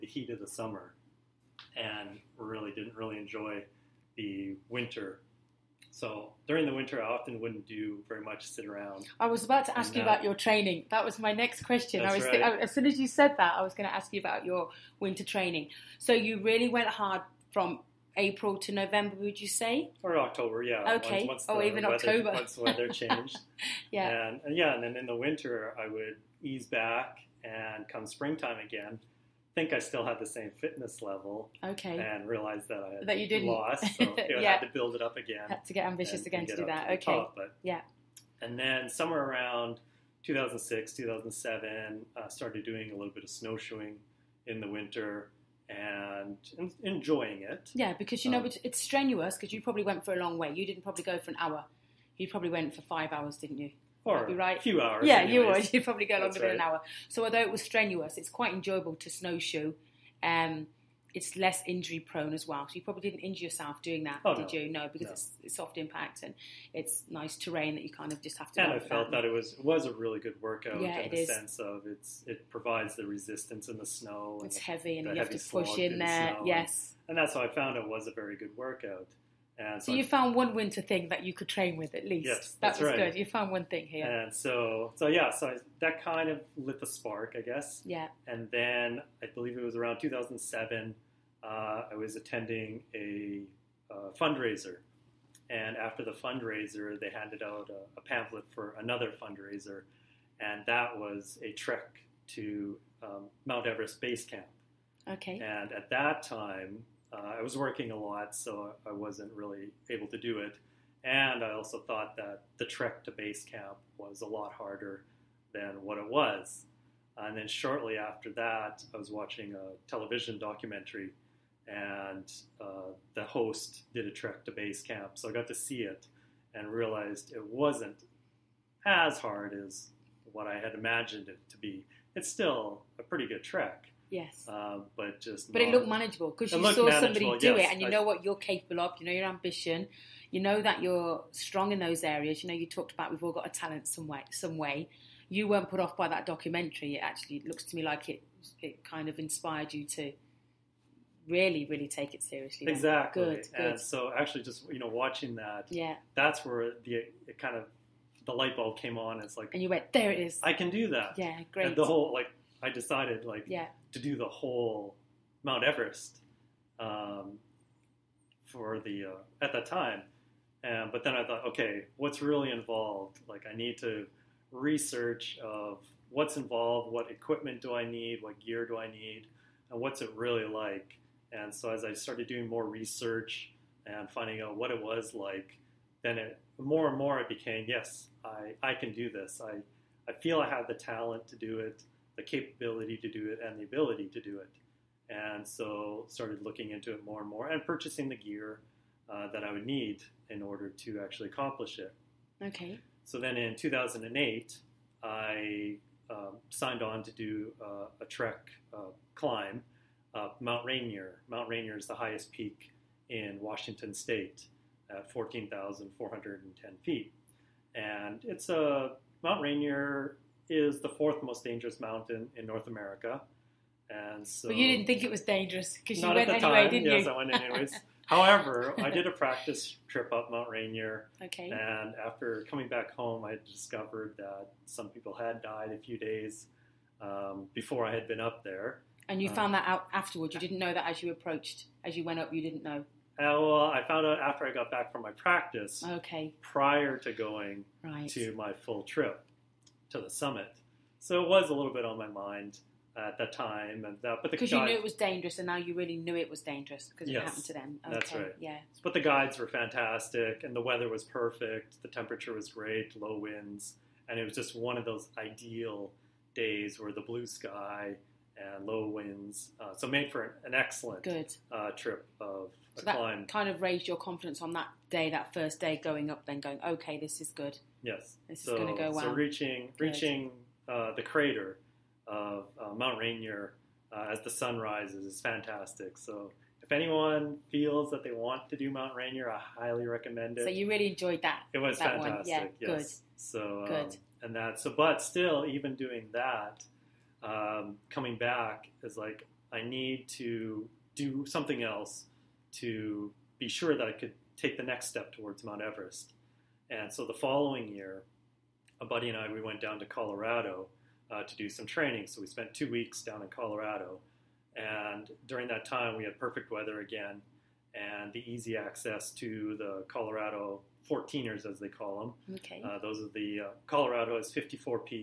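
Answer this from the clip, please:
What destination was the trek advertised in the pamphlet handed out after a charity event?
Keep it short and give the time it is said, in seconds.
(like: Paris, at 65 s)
Mount Everest base camp, at 103 s.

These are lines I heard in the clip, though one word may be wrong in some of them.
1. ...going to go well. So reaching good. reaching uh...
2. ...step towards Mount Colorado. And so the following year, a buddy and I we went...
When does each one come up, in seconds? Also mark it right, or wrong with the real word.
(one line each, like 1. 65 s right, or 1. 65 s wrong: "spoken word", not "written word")
1. 278 s right
2. 304 s wrong: "Everest", not "Colorado".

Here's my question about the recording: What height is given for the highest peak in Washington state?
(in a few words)
14,410 feet.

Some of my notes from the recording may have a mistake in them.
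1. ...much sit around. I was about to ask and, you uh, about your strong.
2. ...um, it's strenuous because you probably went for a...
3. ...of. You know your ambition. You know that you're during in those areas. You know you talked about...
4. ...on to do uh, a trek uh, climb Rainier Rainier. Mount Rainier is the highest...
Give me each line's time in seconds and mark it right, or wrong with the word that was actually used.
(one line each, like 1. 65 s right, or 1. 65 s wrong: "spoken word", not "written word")
1. 8 s wrong: "training", not "strong"
2. 48 s right
3. 138 s wrong: "strong", not "during"
4. 206 s wrong: "Mount", not "Rainier".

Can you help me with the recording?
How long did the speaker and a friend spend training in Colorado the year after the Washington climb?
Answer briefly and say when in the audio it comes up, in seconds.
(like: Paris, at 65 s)
2 weeks, at 312 s.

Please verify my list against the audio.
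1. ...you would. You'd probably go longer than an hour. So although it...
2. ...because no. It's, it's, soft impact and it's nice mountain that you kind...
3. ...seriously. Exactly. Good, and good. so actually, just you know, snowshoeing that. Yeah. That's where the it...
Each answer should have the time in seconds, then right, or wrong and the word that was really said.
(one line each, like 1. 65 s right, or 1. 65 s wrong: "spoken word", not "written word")
1. 55 s right
2. 64 s wrong: "terrain", not "mountain"
3. 152 s wrong: "watching", not "snowshoeing".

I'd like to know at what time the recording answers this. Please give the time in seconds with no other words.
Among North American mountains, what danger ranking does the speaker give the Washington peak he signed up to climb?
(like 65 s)
220 s.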